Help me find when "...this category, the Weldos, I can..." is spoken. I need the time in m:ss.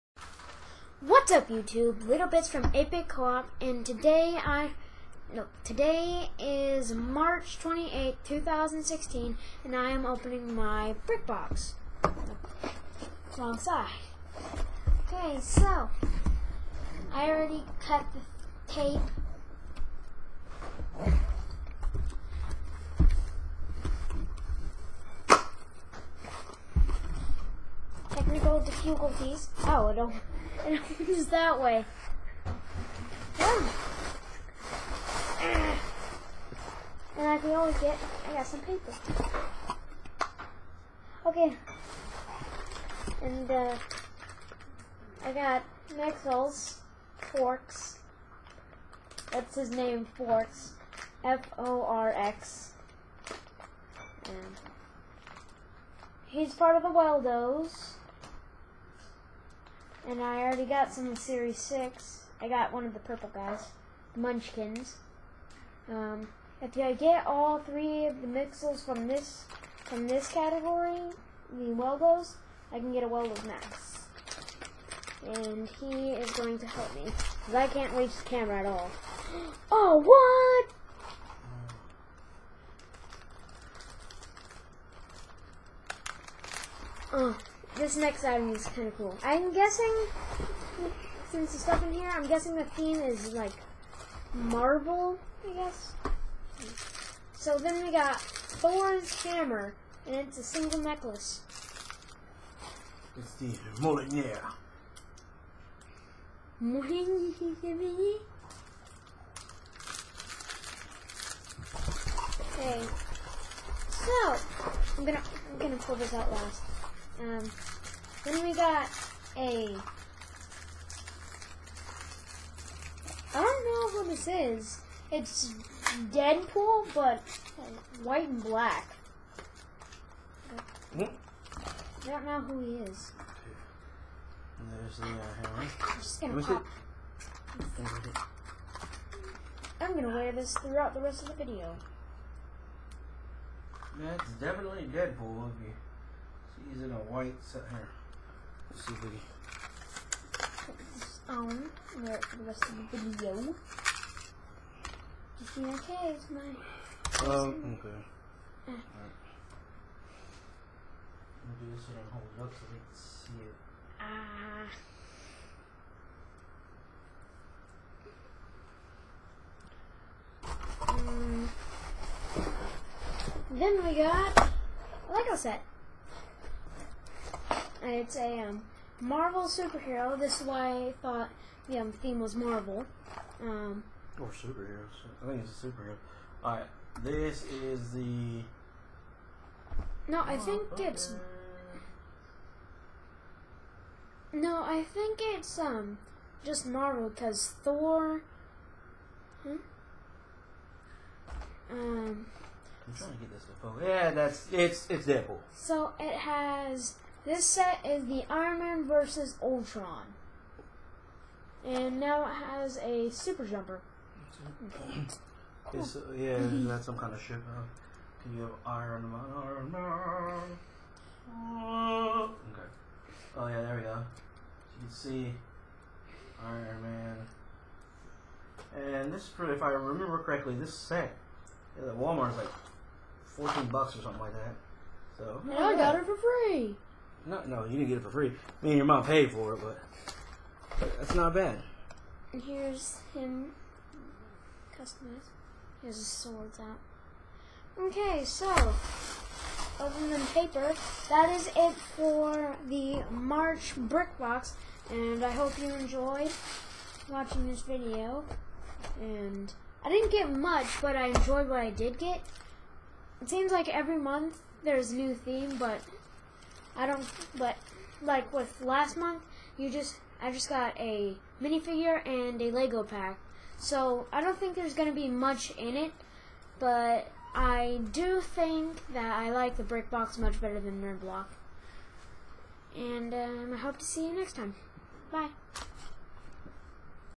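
1:10.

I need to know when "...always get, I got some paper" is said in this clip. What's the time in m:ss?
0:37.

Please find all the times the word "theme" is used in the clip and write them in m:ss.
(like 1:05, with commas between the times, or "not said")
1:32, 3:01, 4:25.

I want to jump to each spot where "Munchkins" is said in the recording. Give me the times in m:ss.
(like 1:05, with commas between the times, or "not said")
1:04.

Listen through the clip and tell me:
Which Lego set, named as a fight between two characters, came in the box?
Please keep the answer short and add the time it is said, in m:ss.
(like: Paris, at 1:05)
Iron Man versus Ultron, at 3:28.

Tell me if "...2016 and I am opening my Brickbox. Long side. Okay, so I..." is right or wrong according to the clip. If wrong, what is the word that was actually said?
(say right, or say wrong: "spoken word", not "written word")
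right.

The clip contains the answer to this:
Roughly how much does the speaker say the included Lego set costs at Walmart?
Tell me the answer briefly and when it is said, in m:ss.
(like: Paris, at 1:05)
$14, at 3:53.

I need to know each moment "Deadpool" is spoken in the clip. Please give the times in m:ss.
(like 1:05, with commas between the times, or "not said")
2:06, 2:24, 3:25.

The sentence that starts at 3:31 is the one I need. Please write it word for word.
And now it has a super jumper.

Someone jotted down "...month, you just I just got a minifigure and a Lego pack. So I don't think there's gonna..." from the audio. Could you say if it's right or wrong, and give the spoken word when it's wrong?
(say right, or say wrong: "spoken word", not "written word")
right.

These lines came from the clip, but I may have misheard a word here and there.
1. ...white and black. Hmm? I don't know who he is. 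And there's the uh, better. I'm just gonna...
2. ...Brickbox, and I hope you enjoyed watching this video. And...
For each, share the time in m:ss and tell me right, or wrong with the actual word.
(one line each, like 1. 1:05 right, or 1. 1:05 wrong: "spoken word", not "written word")
1. 2:08 wrong: "hammer", not "better"
2. 4:13 right.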